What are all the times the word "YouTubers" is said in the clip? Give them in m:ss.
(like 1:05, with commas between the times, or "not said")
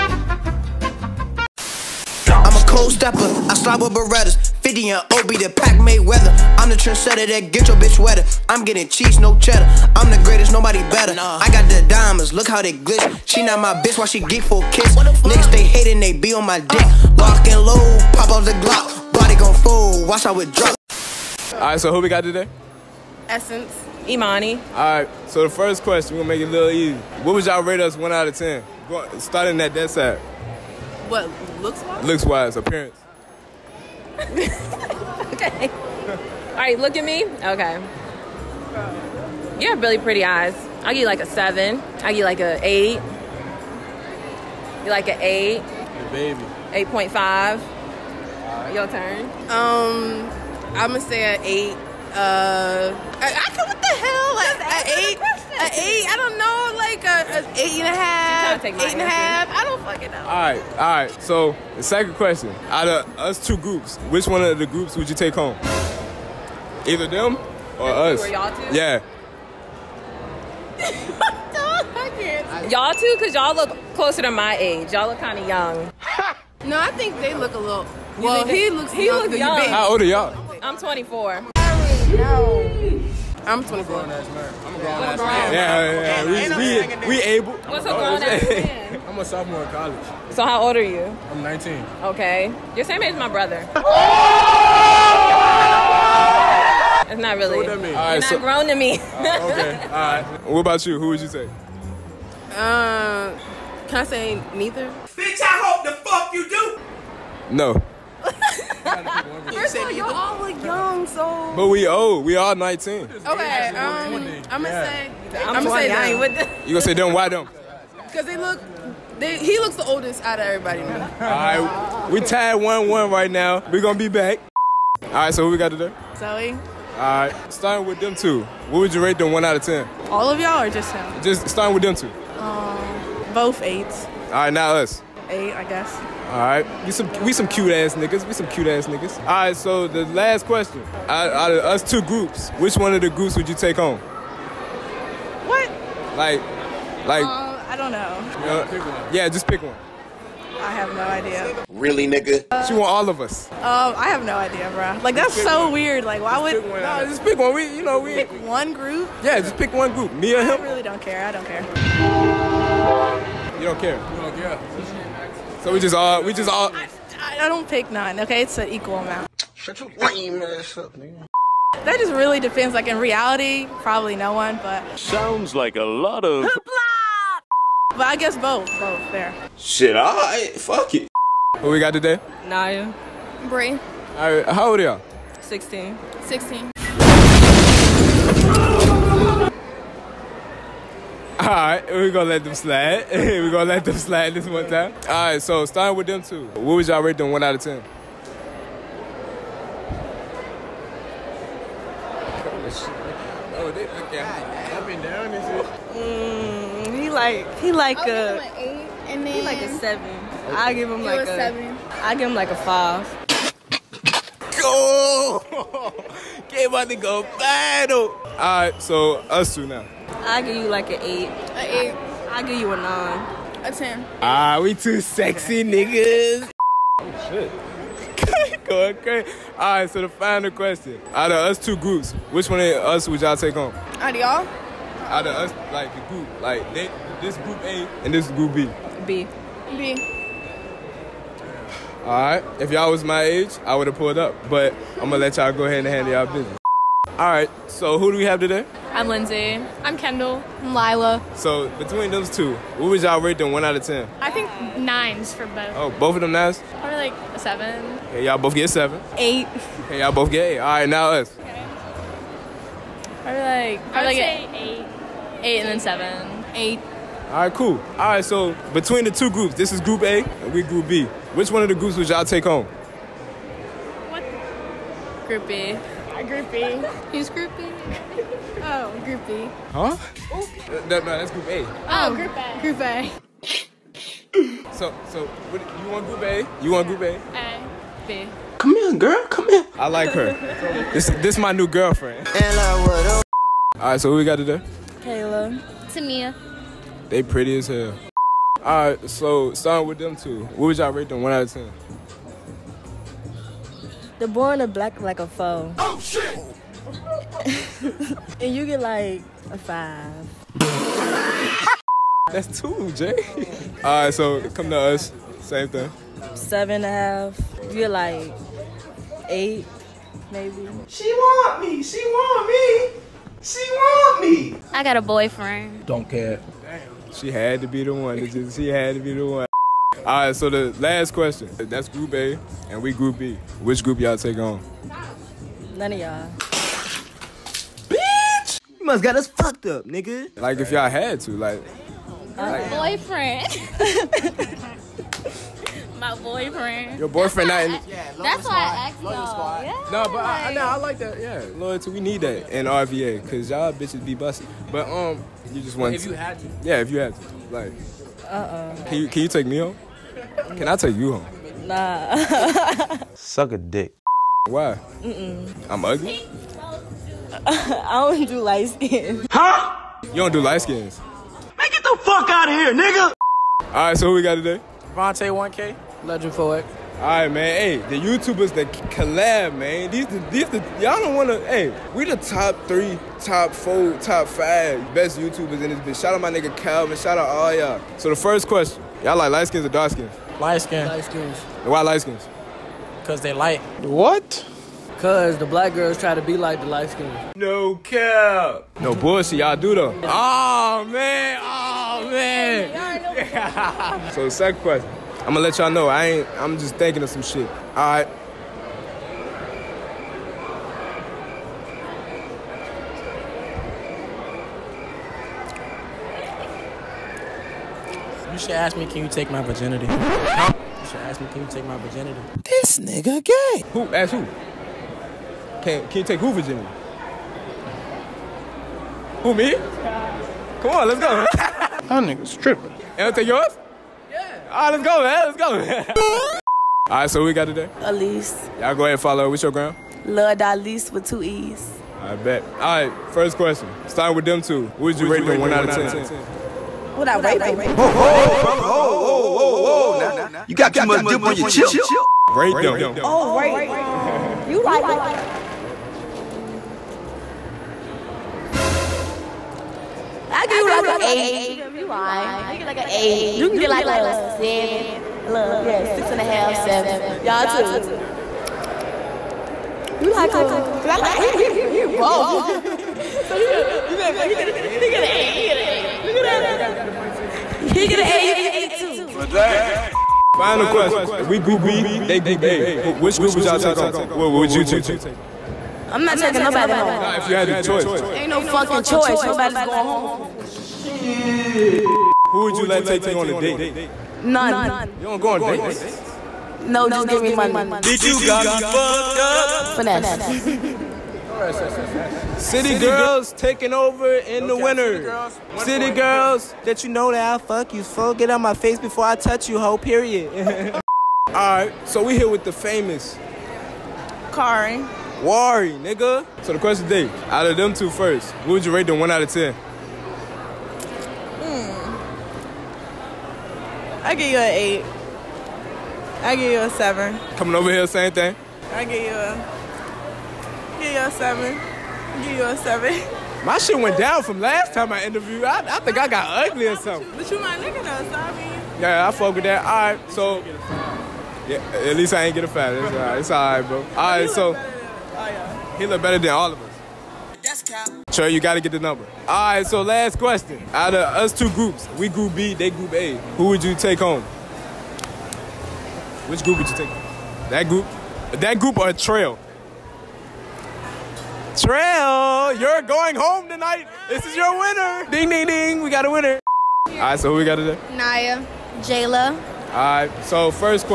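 6:18, 6:25.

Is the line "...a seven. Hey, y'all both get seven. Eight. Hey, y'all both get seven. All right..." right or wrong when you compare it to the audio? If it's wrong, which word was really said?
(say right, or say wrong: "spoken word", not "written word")
wrong: "eight", not "seven".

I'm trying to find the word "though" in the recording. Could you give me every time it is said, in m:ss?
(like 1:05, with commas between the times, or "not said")
6:39, 8:57.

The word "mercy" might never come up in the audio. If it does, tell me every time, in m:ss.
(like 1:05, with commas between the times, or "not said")
not said.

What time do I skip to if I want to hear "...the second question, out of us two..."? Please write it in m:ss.
1:01.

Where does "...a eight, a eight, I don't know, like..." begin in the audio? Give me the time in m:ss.
0:54.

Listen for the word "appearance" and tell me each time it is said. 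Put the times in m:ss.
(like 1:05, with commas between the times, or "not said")
0:32.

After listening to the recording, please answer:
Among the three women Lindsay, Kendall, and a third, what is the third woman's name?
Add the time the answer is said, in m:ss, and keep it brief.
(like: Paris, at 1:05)
Lila, at 4:10.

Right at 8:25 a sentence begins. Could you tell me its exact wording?
City girls, city girls that you know that i fuck you.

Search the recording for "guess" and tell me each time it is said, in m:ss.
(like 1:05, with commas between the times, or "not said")
2:15, 2:58.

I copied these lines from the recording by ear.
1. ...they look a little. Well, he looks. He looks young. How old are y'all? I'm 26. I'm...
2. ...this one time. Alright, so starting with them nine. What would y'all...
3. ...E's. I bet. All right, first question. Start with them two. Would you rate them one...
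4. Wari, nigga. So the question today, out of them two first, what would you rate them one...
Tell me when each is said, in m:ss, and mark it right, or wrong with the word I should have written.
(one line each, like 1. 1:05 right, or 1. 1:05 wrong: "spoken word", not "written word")
1. 1:17 wrong: "24", not "26"
2. 3:14 wrong: "two", not "nine"
3. 7:21 right
4. 8:35 right.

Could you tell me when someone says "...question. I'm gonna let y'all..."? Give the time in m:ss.
6:44.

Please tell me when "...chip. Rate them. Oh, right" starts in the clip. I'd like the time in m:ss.
7:31.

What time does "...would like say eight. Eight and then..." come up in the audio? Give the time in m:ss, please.
4:23.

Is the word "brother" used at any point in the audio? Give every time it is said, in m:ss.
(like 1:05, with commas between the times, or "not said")
1:33, 7:28.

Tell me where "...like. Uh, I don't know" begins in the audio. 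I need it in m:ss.
2:27.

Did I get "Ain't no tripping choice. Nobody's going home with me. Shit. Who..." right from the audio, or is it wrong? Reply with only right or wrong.
wrong.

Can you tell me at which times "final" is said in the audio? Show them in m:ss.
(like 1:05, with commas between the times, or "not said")
3:50, 8:00.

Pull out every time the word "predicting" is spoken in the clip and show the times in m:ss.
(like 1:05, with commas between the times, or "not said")
not said.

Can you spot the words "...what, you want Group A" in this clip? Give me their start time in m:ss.
4:45.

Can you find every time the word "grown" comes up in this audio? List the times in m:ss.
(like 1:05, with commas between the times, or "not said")
1:23, 1:27, 1:38.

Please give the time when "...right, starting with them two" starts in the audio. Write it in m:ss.
2:06.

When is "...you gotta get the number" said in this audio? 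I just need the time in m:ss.
9:08.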